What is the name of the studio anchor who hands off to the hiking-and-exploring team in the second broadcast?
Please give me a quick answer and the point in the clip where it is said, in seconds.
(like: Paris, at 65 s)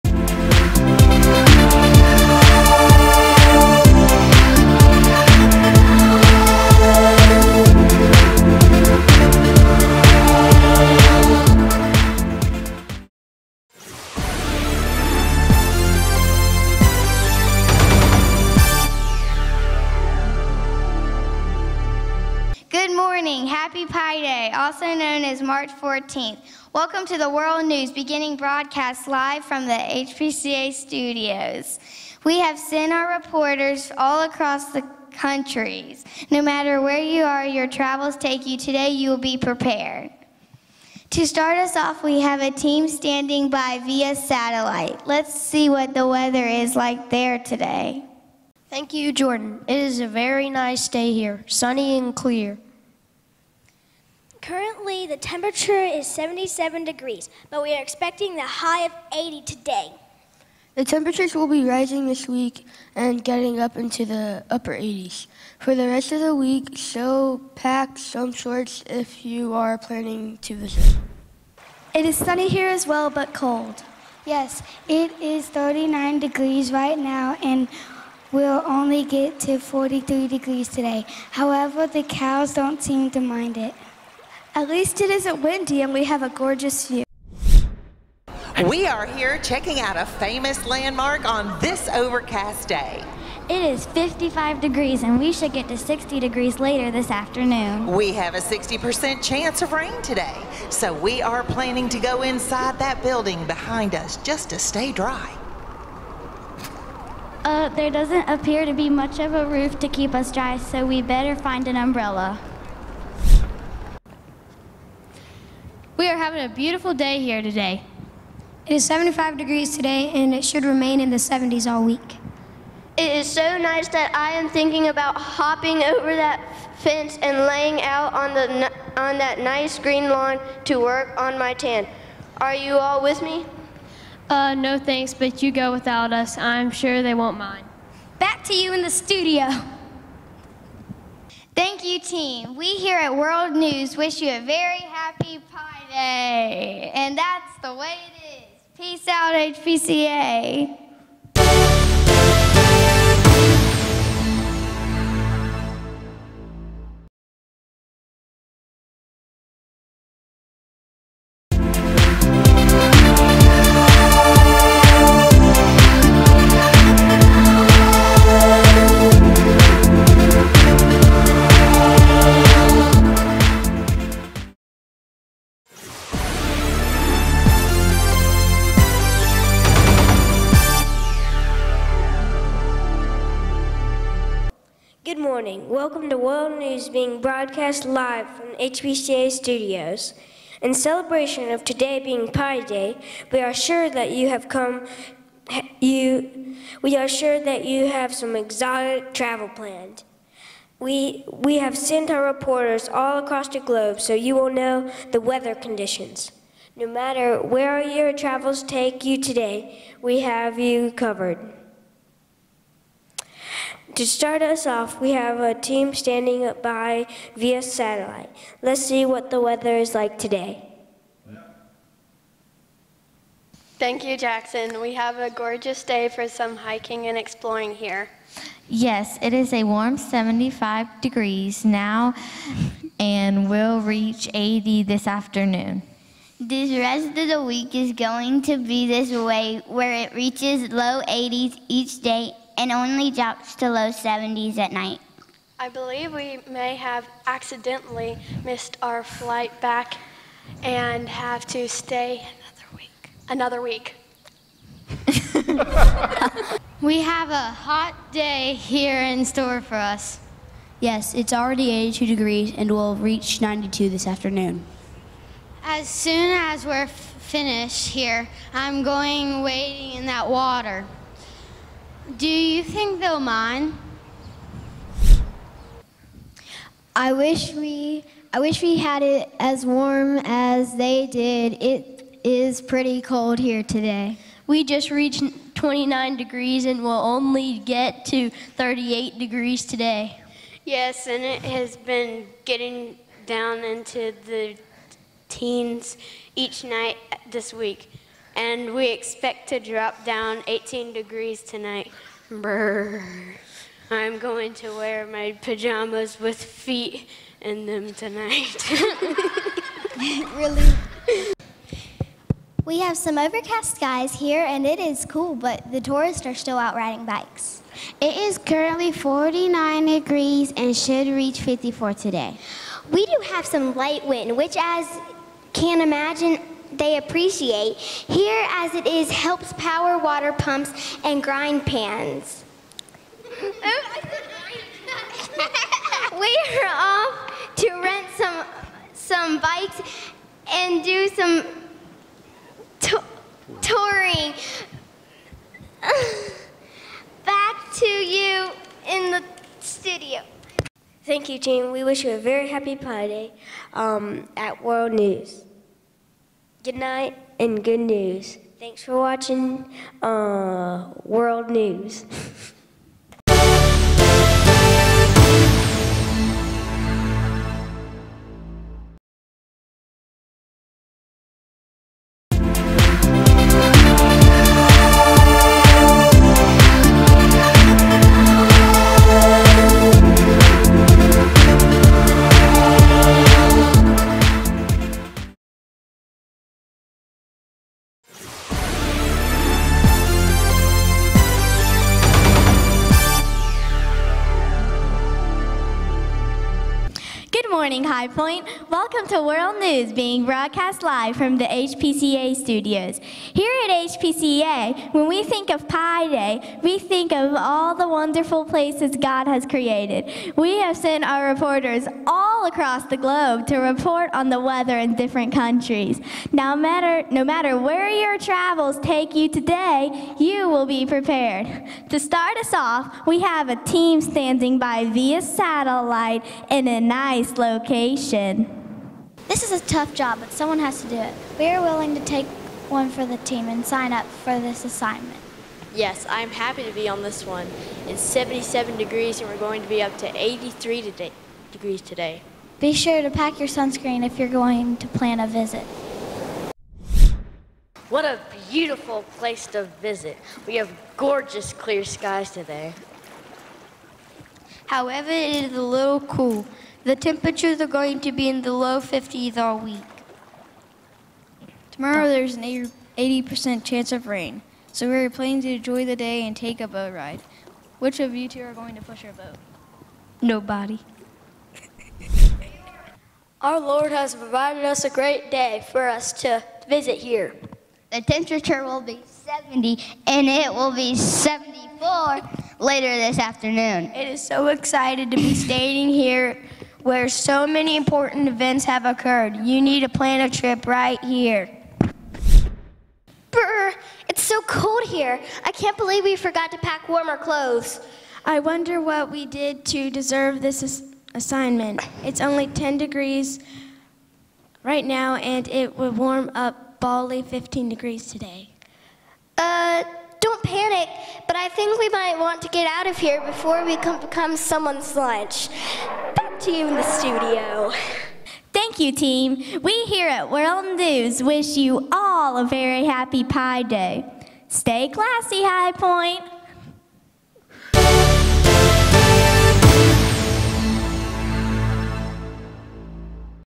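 Jackson, at 224 s.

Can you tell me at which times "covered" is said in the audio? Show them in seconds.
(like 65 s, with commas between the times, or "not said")
210 s.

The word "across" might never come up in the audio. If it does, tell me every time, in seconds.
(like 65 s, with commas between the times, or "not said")
34 s, 203 s, 412 s.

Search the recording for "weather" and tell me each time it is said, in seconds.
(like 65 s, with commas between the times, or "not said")
46 s, 205 s, 219 s, 414 s.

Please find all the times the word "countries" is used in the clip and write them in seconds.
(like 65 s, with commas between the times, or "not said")
35 s, 415 s.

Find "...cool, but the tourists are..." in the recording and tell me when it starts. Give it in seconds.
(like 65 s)
315 s.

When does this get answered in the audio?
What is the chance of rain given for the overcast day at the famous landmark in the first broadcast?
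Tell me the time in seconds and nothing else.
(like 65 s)
98 s.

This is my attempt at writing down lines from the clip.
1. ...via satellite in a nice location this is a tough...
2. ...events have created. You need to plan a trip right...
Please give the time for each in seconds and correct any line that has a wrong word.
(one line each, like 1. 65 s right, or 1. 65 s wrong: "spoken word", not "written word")
1. 424 s right
2. 488 s wrong: "occurred", not "created".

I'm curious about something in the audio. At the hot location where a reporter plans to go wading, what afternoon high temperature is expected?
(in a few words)
92.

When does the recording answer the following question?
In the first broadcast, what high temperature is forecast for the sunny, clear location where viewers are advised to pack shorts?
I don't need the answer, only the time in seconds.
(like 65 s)
58 s.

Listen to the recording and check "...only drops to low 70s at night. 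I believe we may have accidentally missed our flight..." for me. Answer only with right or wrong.
right.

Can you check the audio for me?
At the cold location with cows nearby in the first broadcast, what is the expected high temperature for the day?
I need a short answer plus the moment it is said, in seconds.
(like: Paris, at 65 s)
43, at 79 s.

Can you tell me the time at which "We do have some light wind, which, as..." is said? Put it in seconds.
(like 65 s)
322 s.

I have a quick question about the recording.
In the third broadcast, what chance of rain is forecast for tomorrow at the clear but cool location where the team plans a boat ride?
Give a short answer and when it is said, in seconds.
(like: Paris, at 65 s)
80%, at 462 s.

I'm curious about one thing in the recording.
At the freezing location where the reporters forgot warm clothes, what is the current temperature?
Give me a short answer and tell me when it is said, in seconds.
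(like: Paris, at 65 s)
10 degrees, at 502 s.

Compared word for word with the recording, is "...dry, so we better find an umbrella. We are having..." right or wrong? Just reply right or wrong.
right.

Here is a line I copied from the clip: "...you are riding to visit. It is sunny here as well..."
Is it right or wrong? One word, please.
wrong.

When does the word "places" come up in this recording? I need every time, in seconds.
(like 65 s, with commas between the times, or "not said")
408 s, 449 s.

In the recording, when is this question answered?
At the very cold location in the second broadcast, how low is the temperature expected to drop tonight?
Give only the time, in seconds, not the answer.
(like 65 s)
300 s.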